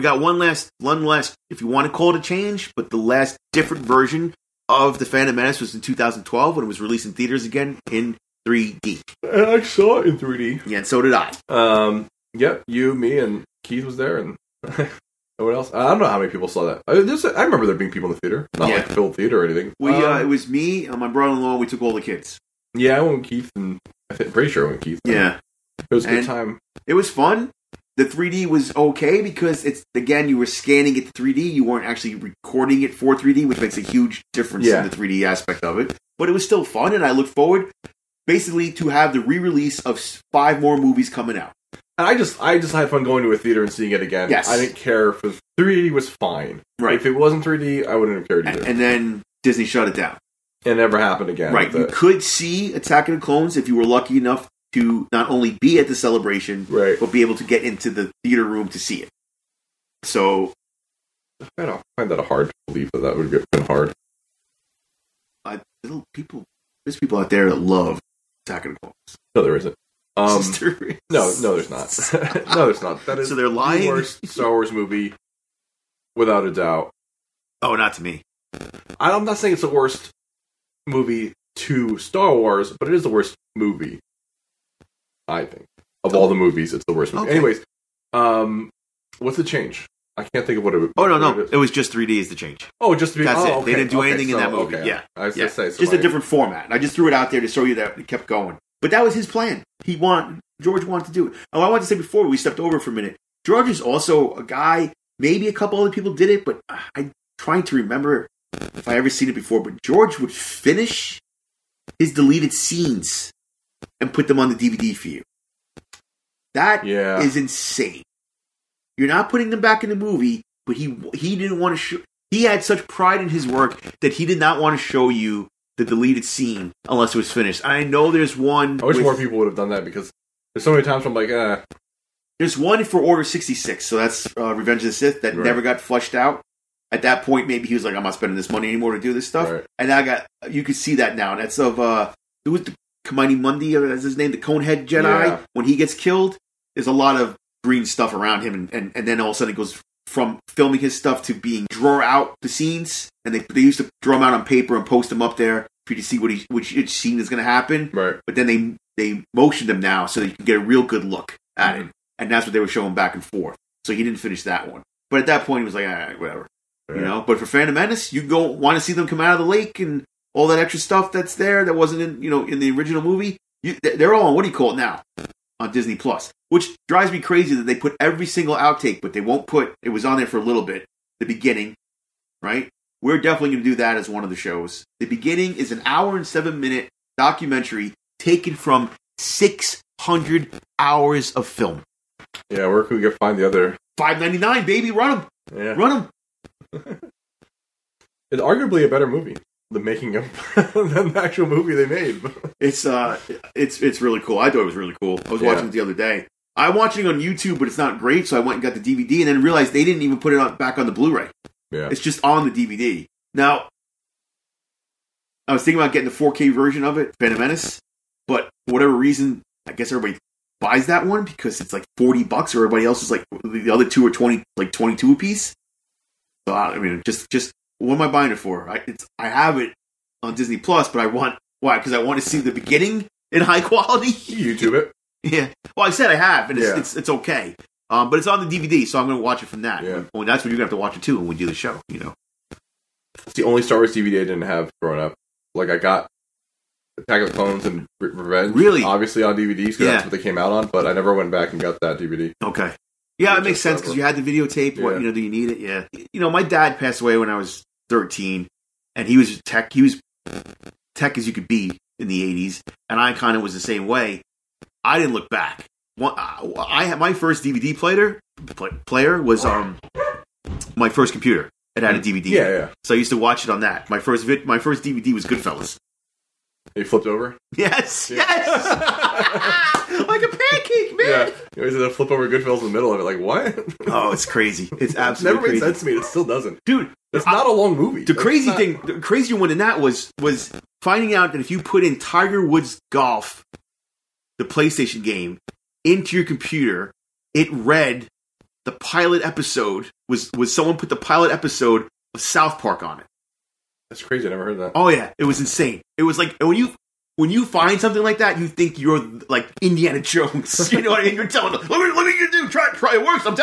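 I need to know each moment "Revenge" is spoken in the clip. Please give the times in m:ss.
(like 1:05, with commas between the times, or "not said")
2:14, 4:07.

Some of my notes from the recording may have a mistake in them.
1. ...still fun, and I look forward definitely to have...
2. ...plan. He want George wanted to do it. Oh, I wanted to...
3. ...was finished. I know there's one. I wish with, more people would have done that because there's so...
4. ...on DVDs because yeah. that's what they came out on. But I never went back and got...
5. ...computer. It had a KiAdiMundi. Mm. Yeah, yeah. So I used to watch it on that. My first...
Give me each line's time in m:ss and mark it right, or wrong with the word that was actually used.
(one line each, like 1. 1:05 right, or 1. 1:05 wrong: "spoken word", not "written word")
1. 0:36 wrong: "basically", not "definitely"
2. 1:39 right
3. 2:07 right
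4. 4:09 right
5. 4:31 wrong: "DVD", not "KiAdiMundi".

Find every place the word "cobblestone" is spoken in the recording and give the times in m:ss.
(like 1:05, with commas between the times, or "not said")
not said.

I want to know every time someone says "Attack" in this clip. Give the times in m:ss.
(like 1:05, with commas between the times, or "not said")
0:52, 1:08, 4:06.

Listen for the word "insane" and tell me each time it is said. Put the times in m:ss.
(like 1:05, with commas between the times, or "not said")
1:57, 5:05.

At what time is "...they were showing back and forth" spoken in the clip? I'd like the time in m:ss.
2:42.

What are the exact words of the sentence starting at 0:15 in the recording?
I don't know how many people saw that.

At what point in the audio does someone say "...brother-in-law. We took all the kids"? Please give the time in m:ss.
0:21.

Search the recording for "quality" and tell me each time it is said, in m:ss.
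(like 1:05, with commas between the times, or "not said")
3:53.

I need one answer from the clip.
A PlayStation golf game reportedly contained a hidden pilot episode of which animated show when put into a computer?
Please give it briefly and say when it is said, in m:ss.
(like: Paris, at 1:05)
South Park, at 5:02.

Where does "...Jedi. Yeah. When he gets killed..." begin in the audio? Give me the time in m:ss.
2:24.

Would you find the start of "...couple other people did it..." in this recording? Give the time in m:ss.
1:45.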